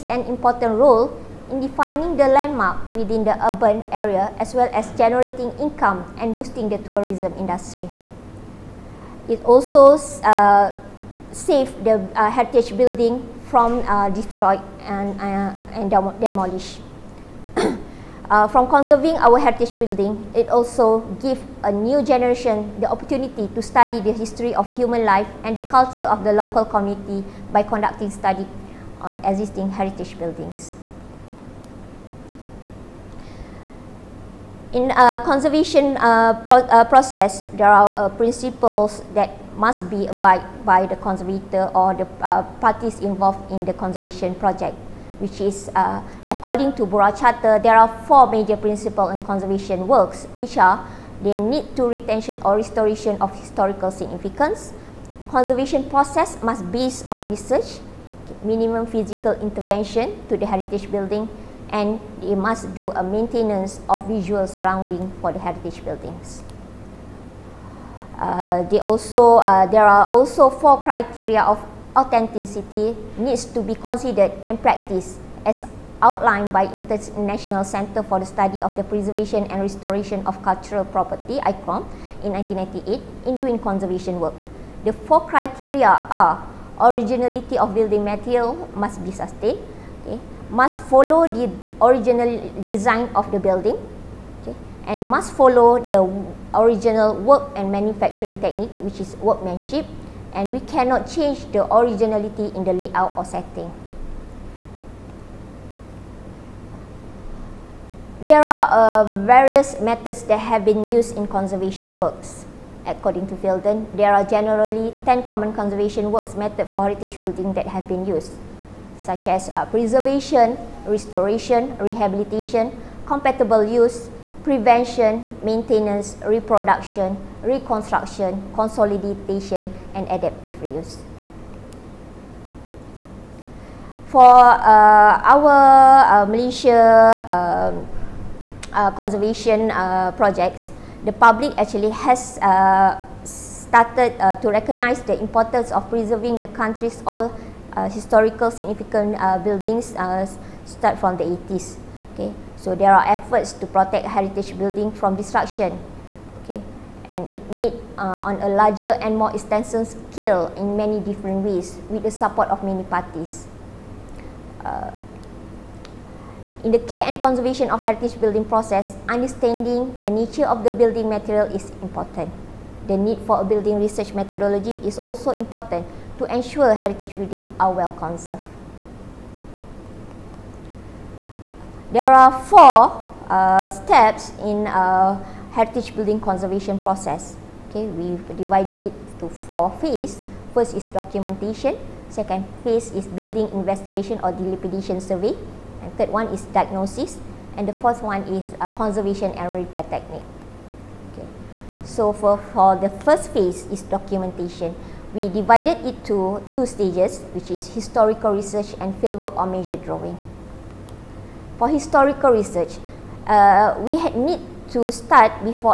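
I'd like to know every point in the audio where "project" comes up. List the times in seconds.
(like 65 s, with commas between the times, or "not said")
44 s, 140 s.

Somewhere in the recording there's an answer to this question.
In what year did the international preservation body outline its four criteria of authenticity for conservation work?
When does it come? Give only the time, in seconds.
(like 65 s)
82 s.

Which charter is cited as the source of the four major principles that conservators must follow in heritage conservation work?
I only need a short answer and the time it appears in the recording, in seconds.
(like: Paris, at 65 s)
Burra Charter, at 46 s.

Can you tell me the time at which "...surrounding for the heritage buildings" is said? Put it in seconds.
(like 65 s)
64 s.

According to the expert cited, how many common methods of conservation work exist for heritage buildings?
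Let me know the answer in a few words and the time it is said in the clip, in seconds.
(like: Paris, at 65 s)
10, at 115 s.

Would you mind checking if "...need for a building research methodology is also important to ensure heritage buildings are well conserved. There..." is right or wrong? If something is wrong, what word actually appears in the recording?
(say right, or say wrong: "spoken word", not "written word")
right.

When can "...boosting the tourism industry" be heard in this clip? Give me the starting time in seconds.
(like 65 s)
6 s.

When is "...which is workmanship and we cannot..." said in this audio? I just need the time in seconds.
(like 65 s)
98 s.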